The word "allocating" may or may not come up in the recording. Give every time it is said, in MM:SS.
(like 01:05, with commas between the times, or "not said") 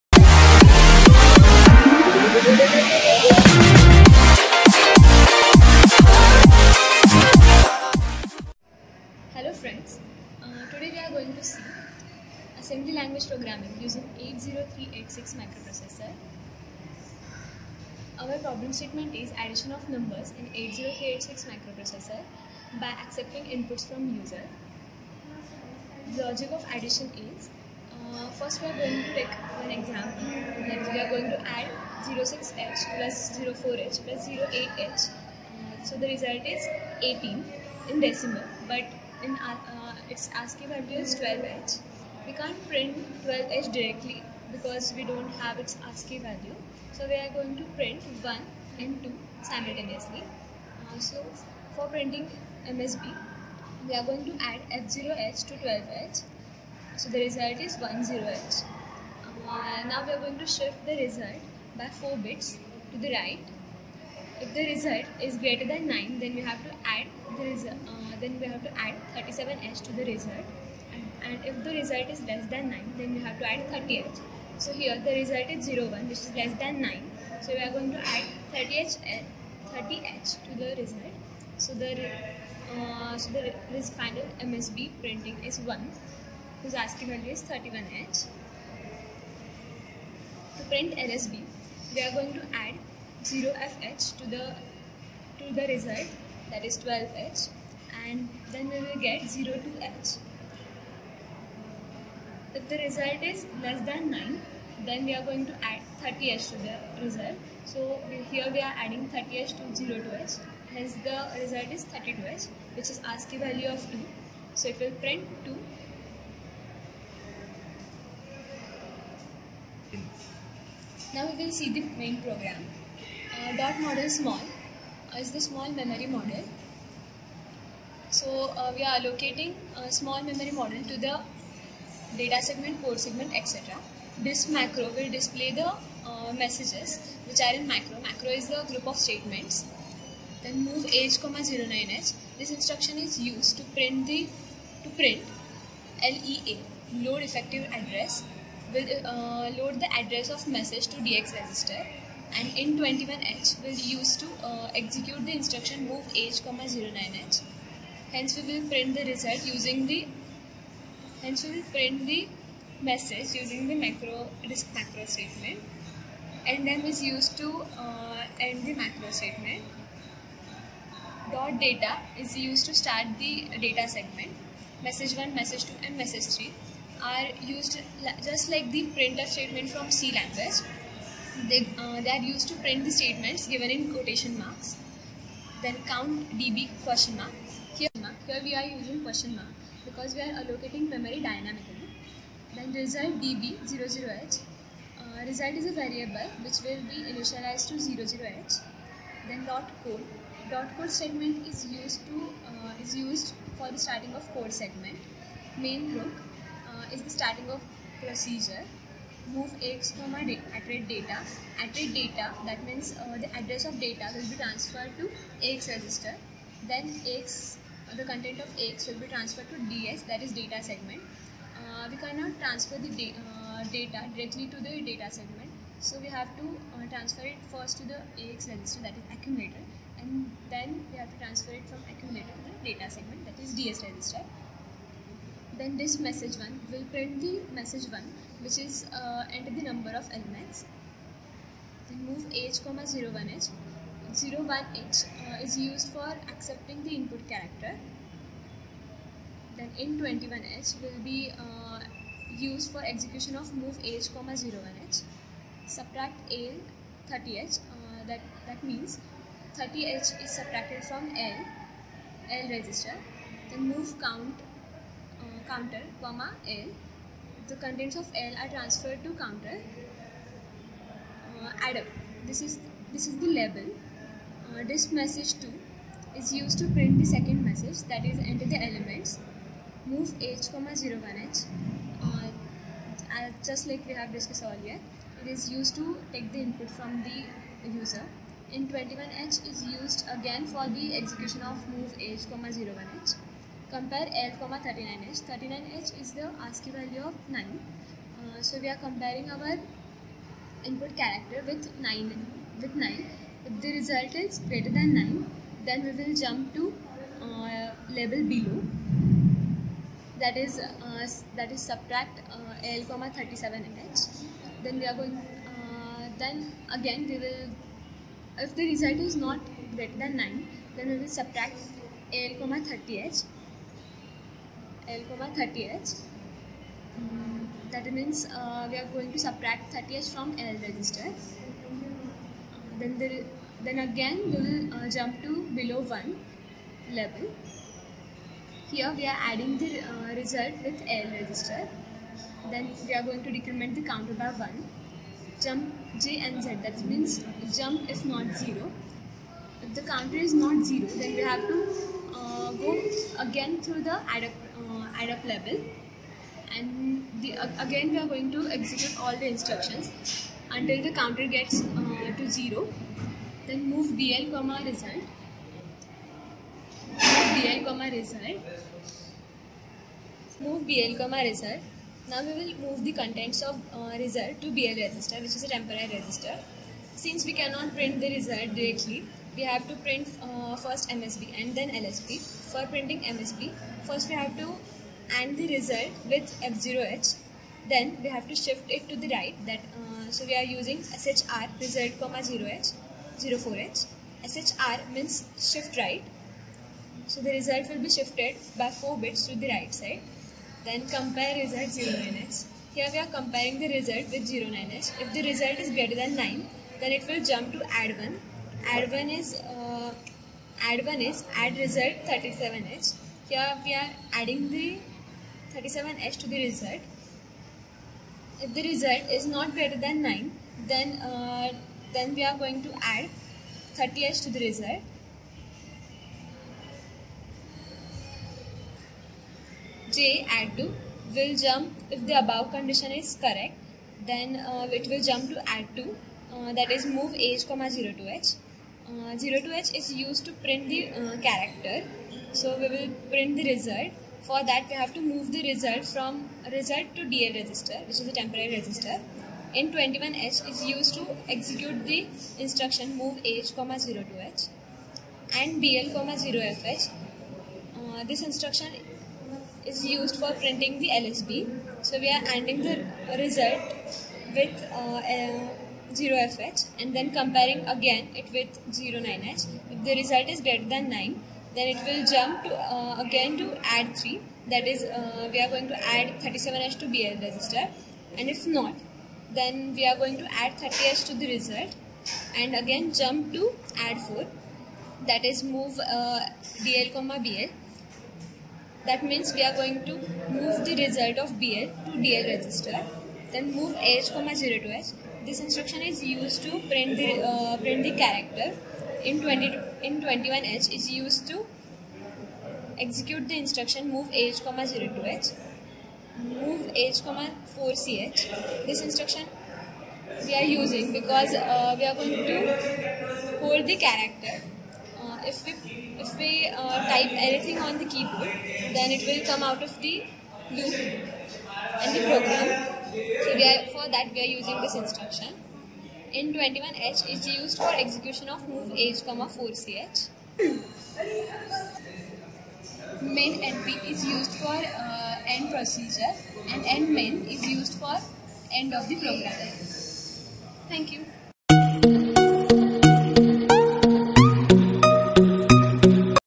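02:08, 03:10.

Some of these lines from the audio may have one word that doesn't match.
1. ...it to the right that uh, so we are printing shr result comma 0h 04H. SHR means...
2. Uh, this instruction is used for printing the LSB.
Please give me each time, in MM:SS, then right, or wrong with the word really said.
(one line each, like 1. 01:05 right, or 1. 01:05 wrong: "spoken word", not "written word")
1. 06:28 wrong: "using", not "printing"
2. 07:37 right.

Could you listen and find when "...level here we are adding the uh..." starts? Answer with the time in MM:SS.
05:36.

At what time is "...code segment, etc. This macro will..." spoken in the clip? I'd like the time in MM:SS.
02:12.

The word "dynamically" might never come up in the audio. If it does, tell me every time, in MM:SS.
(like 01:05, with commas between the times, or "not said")
03:11.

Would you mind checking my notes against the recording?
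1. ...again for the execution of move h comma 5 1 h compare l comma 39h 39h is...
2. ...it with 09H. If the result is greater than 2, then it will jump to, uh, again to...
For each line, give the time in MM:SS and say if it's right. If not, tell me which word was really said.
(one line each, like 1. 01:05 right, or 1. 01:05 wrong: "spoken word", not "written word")
1. 04:50 wrong: "0", not "5"
2. 07:48 wrong: "9", not "2".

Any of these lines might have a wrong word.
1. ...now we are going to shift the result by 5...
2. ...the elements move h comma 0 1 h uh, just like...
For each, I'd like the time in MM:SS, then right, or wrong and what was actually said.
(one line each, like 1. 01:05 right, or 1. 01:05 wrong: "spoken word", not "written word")
1. 00:59 wrong: "4", not "5"
2. 04:38 right.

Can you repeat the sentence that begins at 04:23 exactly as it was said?
Then move count uh, counter comma L.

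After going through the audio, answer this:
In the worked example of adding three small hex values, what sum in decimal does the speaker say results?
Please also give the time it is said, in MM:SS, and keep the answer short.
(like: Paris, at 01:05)
18, at 00:37.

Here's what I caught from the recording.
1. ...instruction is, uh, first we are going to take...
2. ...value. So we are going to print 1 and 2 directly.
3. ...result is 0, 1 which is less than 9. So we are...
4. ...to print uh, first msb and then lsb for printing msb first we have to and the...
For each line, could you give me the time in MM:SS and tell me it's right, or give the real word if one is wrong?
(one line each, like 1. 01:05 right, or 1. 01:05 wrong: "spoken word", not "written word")
1. 00:26 wrong: "addition", not "instruction"
2. 00:46 wrong: "simultaneously", not "directly"
3. 01:15 right
4. 06:19 right.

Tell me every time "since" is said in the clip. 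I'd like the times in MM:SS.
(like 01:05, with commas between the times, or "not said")
06:17.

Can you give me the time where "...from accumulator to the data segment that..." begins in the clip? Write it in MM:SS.
03:51.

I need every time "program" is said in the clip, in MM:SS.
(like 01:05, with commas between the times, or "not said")
02:02, 08:42, 08:58.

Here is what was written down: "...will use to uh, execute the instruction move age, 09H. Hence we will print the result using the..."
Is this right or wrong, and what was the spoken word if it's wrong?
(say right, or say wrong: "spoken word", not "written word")
right.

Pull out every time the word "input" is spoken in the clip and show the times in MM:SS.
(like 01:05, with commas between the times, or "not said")
00:23, 04:06, 04:46, 05:00.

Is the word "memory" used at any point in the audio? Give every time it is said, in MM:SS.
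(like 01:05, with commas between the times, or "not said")
02:05, 02:10, 03:10.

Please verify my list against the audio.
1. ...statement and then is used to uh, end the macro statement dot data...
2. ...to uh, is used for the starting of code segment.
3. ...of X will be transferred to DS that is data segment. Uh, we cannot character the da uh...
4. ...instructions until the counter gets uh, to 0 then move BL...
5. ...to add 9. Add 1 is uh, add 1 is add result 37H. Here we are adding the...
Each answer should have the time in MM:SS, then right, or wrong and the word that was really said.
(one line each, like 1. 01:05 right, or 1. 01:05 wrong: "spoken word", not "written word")
1. 02:45 right
2. 03:22 right
3. 03:38 wrong: "transfer", not "character"
4. 05:59 right
5. 06:47 wrong: "1", not "9".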